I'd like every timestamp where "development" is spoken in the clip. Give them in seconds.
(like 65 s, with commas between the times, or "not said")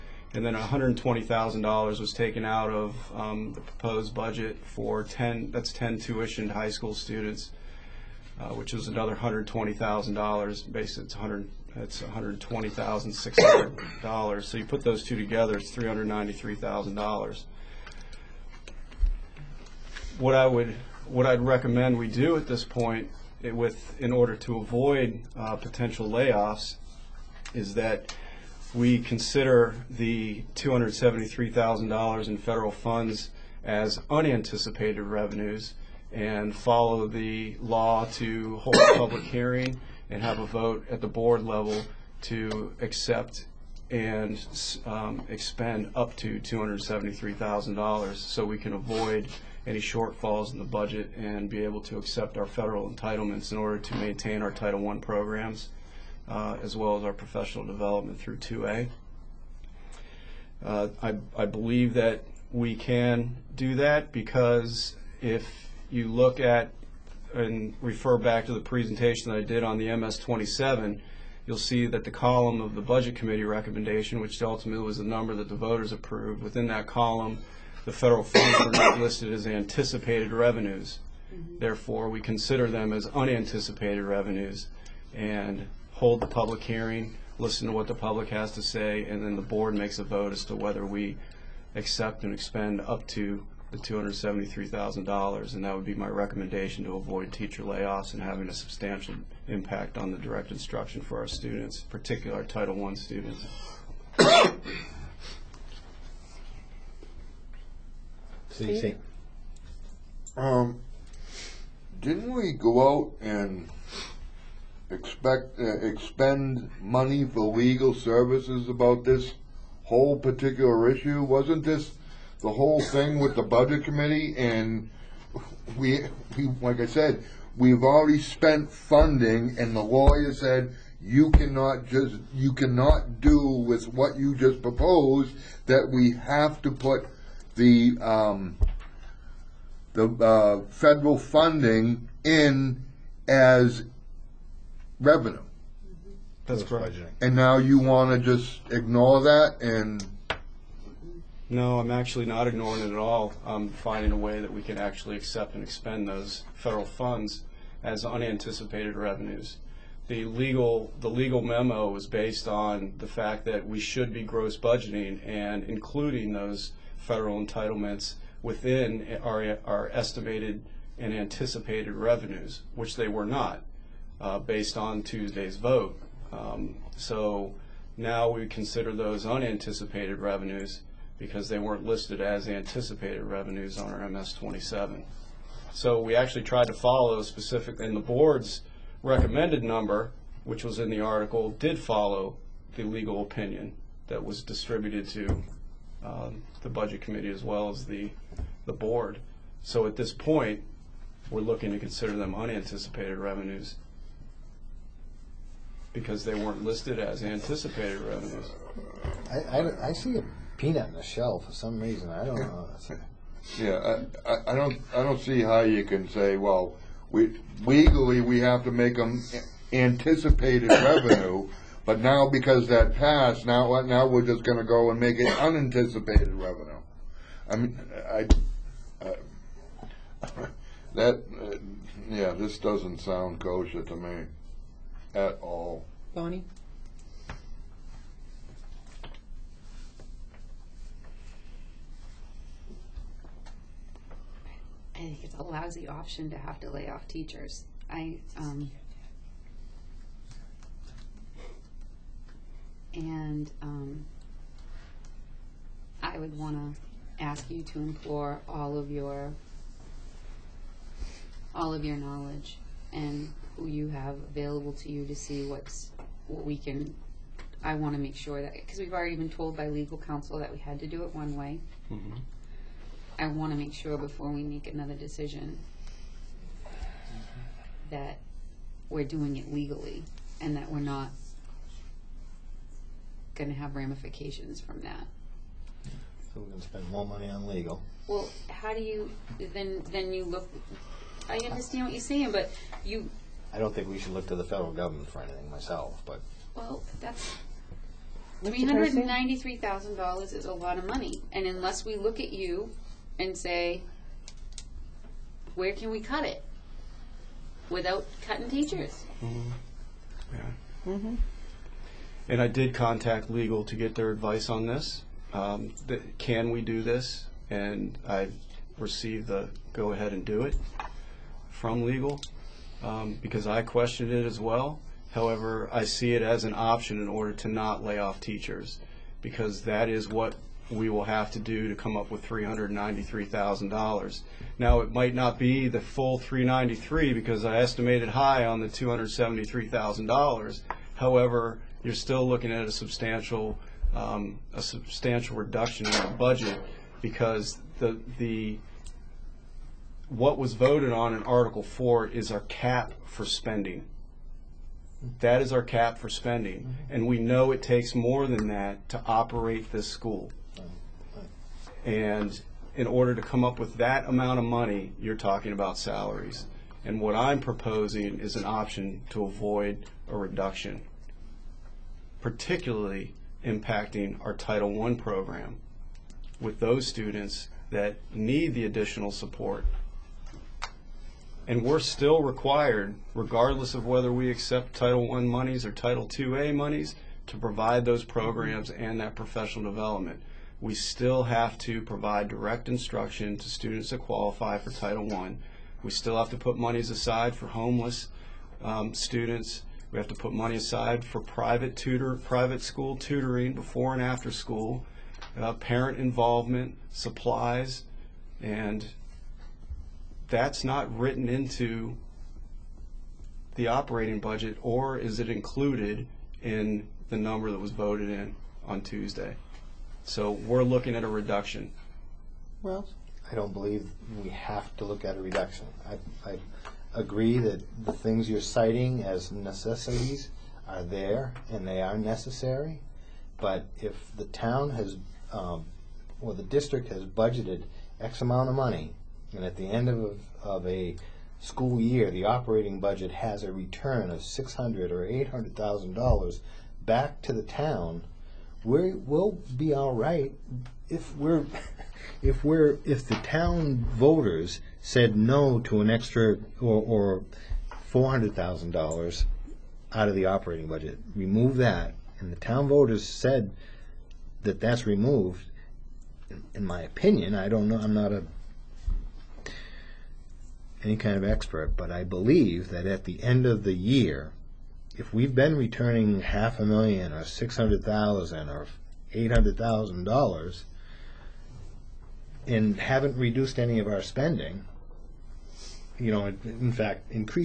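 57 s, 389 s.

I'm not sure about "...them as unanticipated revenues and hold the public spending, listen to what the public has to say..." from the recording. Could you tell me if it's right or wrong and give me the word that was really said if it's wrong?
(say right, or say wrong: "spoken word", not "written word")
wrong: "hearing", not "spending".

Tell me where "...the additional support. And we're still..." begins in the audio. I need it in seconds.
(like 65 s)
378 s.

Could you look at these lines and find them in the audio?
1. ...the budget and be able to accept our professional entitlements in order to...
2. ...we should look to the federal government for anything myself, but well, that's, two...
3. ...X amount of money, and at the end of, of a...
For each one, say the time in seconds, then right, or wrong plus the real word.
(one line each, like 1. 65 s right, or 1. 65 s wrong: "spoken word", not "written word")
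1. 50 s wrong: "federal", not "professional"
2. 293 s wrong: "three", not "two"
3. 437 s right.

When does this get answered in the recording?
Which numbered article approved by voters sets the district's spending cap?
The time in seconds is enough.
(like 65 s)
351 s.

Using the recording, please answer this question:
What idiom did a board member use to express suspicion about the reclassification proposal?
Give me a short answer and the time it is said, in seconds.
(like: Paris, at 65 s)
a peanut in the shell, at 210 s.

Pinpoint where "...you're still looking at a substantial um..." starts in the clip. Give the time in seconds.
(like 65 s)
341 s.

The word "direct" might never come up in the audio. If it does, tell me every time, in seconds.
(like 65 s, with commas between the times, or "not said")
100 s, 392 s.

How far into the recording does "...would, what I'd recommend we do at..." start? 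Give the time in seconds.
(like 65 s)
20 s.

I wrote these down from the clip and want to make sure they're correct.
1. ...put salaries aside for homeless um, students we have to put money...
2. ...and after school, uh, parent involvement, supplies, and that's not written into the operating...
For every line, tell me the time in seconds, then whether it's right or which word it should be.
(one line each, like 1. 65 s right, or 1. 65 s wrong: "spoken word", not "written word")
1. 396 s wrong: "monies", not "salaries"
2. 403 s right.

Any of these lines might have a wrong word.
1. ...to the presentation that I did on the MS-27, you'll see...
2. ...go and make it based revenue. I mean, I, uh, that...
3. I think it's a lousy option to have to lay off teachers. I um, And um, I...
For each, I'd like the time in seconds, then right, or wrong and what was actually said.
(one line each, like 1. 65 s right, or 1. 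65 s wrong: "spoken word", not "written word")
1. 68 s right
2. 224 s wrong: "unanticipated", not "based"
3. 244 s right.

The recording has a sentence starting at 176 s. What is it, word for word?
Um, so now we consider those unanticipated revenues because they weren't listed as anticipated revenues on our MS-27.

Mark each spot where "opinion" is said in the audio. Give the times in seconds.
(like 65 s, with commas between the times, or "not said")
193 s, 466 s.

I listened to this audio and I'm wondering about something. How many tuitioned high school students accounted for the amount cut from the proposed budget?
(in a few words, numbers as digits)
10.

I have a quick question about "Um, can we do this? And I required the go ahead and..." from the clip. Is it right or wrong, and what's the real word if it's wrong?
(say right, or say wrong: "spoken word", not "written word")
wrong: "received", not "required".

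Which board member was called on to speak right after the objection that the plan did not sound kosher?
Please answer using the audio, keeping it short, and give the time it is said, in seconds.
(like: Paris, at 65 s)
Bonnie, at 236 s.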